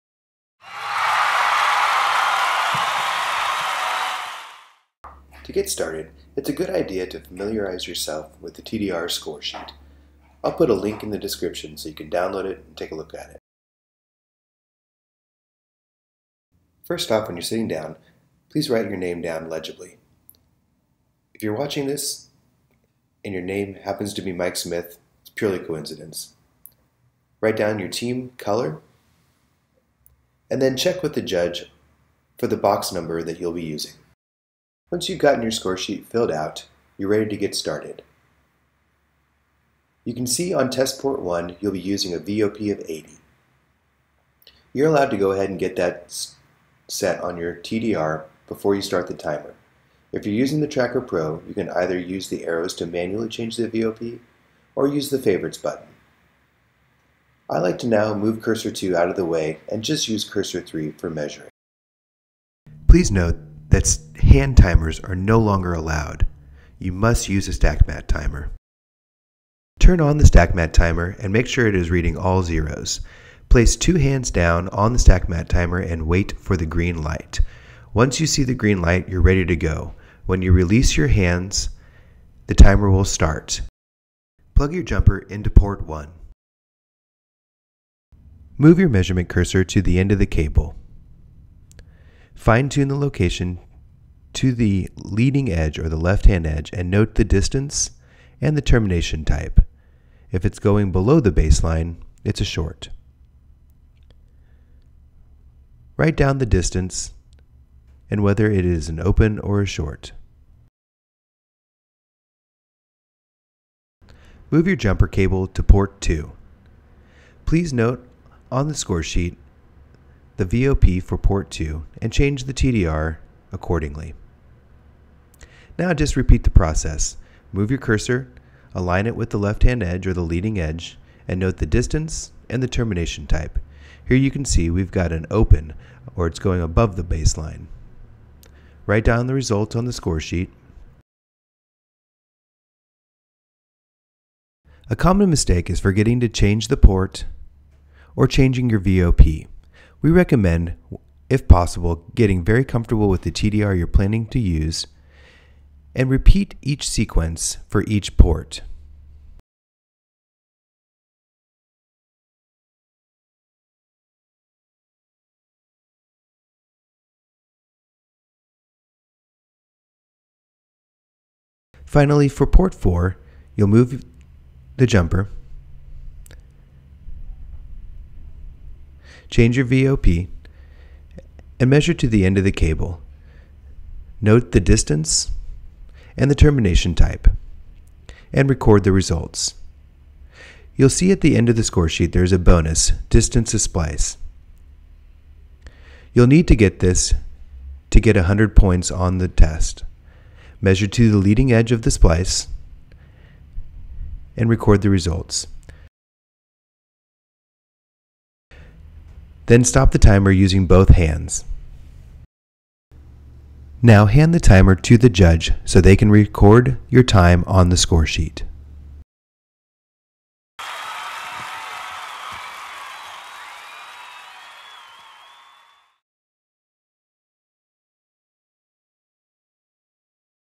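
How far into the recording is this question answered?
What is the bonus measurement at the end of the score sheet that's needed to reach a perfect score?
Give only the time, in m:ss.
3:13.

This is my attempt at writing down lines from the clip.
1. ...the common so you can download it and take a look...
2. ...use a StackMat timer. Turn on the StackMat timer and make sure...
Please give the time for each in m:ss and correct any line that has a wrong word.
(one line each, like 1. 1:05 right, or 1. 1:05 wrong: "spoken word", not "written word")
1. 0:11 wrong: "description", not "common"
2. 1:07 right.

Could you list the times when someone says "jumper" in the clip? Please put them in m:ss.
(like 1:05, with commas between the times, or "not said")
1:24, 1:54, 2:54.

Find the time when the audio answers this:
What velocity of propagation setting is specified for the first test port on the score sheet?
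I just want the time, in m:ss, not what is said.
0:42.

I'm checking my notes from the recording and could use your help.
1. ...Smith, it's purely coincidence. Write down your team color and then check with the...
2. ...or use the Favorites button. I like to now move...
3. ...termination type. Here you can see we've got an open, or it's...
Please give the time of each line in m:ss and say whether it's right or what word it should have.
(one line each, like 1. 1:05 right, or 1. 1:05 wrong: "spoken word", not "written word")
1. 0:24 right
2. 0:54 right
3. 2:12 right.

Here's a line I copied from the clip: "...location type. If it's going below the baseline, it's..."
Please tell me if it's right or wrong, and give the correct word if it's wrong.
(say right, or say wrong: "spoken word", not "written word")
wrong: "termination", not "location".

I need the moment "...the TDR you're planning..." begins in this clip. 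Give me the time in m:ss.
2:33.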